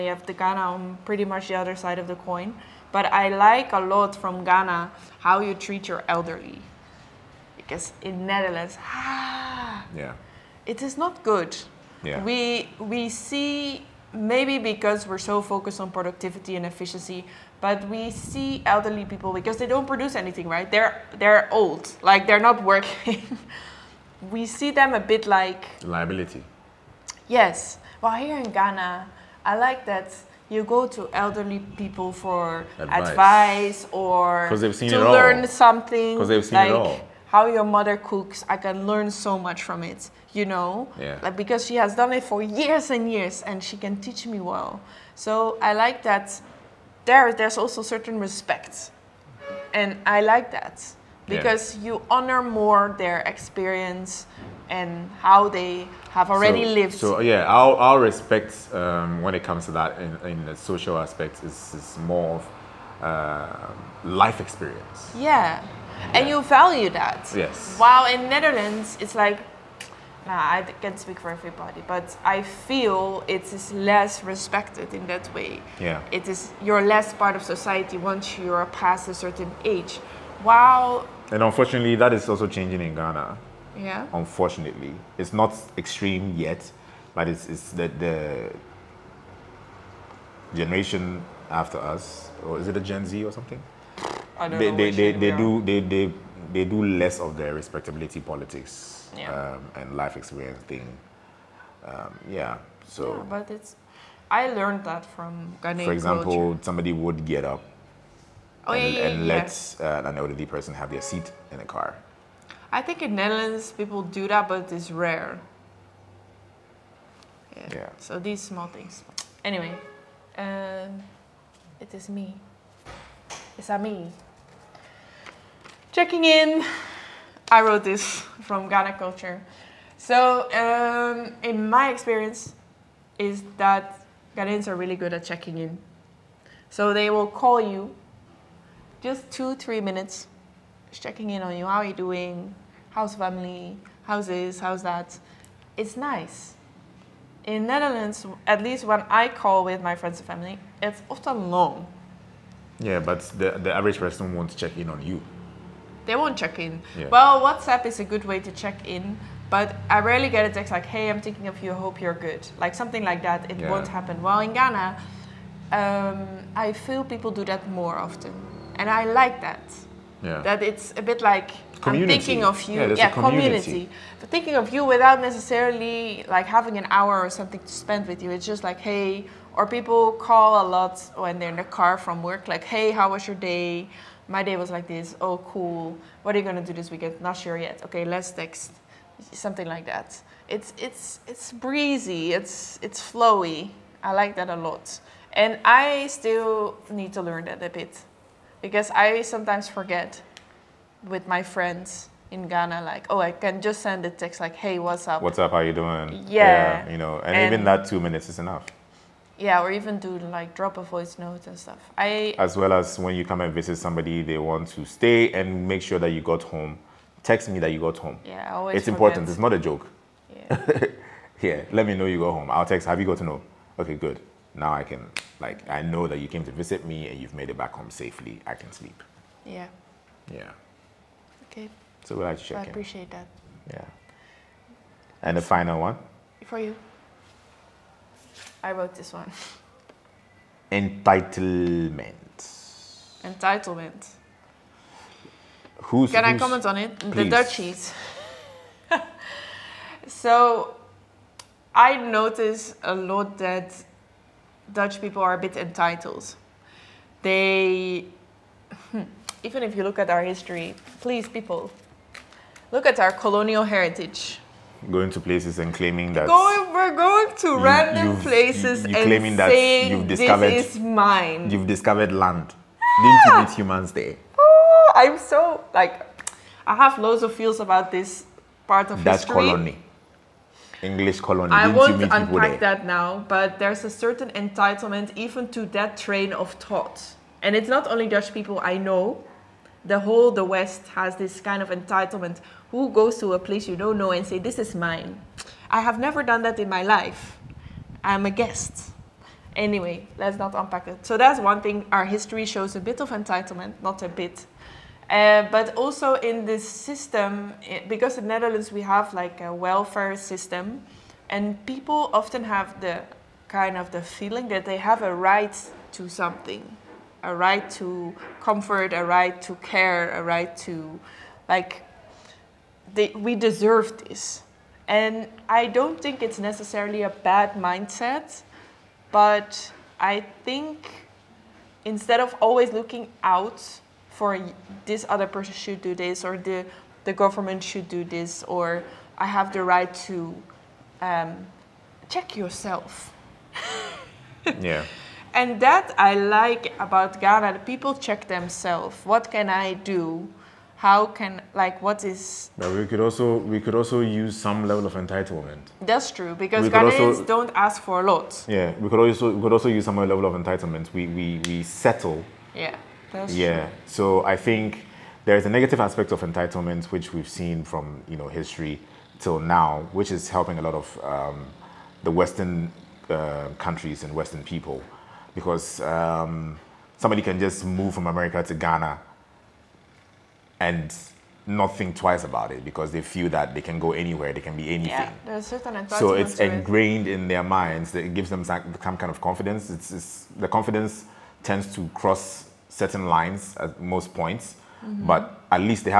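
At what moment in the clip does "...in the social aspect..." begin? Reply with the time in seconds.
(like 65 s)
60 s.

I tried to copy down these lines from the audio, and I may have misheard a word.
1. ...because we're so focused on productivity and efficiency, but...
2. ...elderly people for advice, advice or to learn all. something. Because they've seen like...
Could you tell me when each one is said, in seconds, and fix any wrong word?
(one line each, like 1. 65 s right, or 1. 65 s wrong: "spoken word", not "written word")
1. 14 s right
2. 31 s right.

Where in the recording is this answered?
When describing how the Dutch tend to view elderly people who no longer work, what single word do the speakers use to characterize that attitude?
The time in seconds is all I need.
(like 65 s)
25 s.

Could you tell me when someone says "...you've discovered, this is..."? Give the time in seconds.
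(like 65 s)
269 s.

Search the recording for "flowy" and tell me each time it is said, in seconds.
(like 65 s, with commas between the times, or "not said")
193 s.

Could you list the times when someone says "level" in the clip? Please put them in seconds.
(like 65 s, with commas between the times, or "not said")
354 s, 359 s.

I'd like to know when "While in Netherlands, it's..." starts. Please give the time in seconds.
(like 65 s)
67 s.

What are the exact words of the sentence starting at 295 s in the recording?
I have never done that in my life.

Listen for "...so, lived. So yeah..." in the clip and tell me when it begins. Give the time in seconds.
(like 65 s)
56 s.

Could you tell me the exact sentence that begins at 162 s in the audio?
Like something like that, it yeah.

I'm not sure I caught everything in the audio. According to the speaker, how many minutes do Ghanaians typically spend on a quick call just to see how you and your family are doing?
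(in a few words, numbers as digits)
2 to 3 minutes.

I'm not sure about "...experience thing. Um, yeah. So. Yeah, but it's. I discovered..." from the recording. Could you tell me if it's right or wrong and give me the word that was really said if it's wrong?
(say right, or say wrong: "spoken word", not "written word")
wrong: "learned", not "discovered".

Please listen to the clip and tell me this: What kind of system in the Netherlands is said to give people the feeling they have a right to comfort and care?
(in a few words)
A welfare system.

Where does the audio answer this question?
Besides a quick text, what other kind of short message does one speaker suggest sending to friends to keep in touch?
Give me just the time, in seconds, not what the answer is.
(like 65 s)
210 s.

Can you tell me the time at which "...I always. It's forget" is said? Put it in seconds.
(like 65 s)
218 s.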